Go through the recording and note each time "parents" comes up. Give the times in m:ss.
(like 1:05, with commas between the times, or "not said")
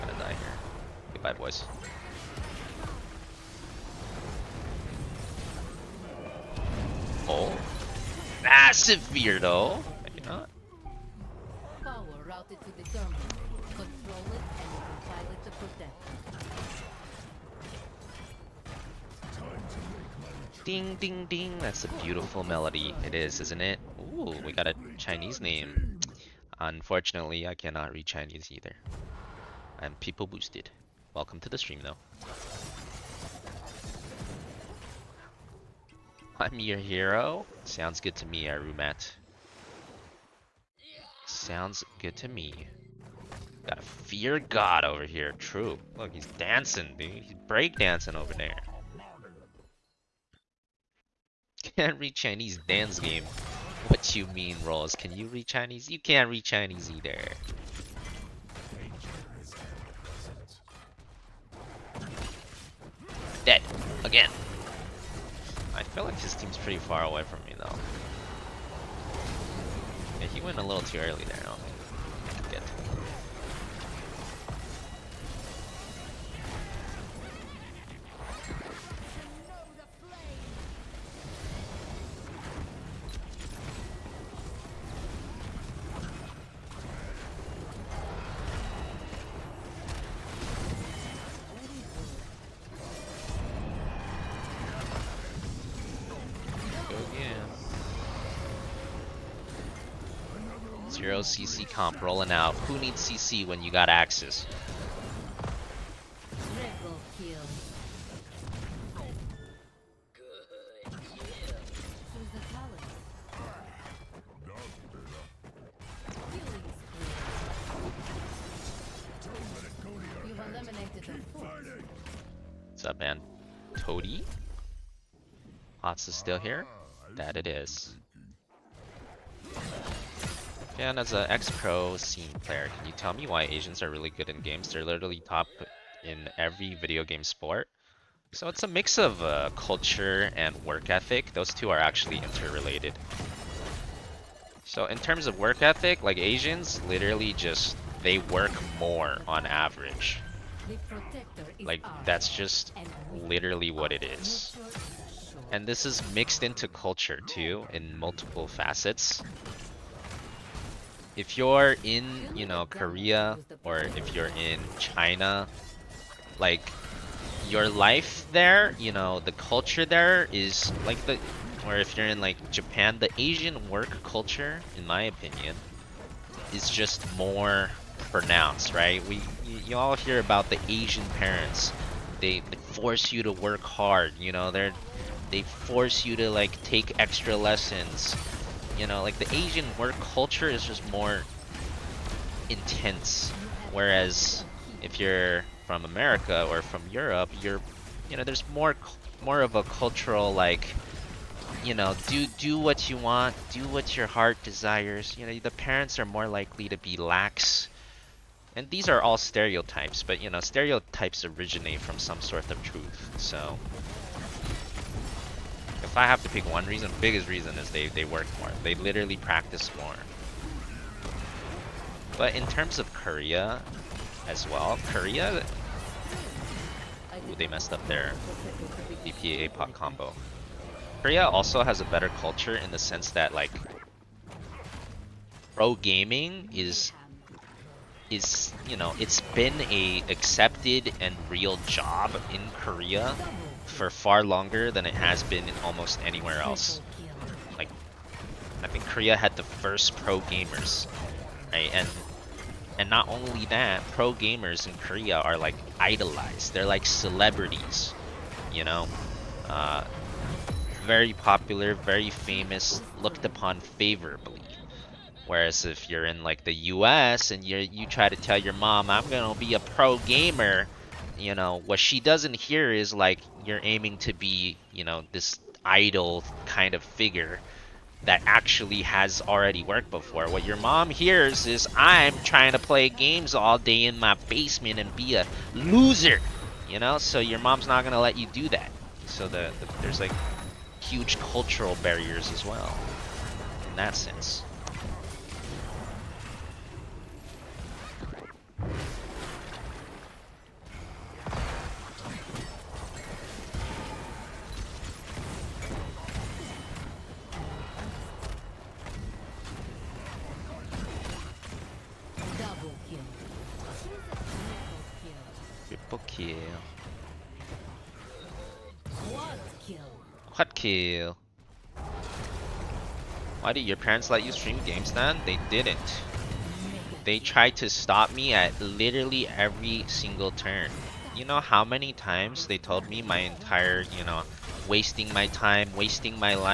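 3:01, 3:25, 5:23.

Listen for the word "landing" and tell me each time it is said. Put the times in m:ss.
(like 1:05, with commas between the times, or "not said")
not said.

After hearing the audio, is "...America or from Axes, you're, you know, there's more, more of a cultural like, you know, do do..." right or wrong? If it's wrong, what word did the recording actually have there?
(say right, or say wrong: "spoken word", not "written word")
wrong: "Europe", not "Axes".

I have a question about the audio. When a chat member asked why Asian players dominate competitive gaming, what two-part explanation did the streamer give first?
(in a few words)
Culture and work ethic.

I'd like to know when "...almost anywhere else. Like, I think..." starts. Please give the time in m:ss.
4:05.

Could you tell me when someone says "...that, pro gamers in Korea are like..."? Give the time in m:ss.
4:13.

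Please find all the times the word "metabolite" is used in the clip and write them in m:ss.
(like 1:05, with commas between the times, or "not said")
not said.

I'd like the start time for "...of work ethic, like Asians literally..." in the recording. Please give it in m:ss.
2:25.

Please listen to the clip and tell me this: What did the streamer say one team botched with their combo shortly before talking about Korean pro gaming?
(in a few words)
BPA pop combo.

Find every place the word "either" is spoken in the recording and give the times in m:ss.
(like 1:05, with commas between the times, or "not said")
0:28, 0:56.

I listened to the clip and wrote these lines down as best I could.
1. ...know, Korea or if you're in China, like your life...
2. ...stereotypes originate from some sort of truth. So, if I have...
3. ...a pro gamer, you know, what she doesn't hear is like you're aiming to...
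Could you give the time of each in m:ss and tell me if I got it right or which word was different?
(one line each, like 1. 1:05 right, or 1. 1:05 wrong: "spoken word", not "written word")
1. 2:42 right
2. 3:30 right
3. 4:29 right.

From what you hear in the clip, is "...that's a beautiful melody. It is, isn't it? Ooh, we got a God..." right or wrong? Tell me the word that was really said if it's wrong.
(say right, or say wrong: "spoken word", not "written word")
wrong: "Chinese", not "God".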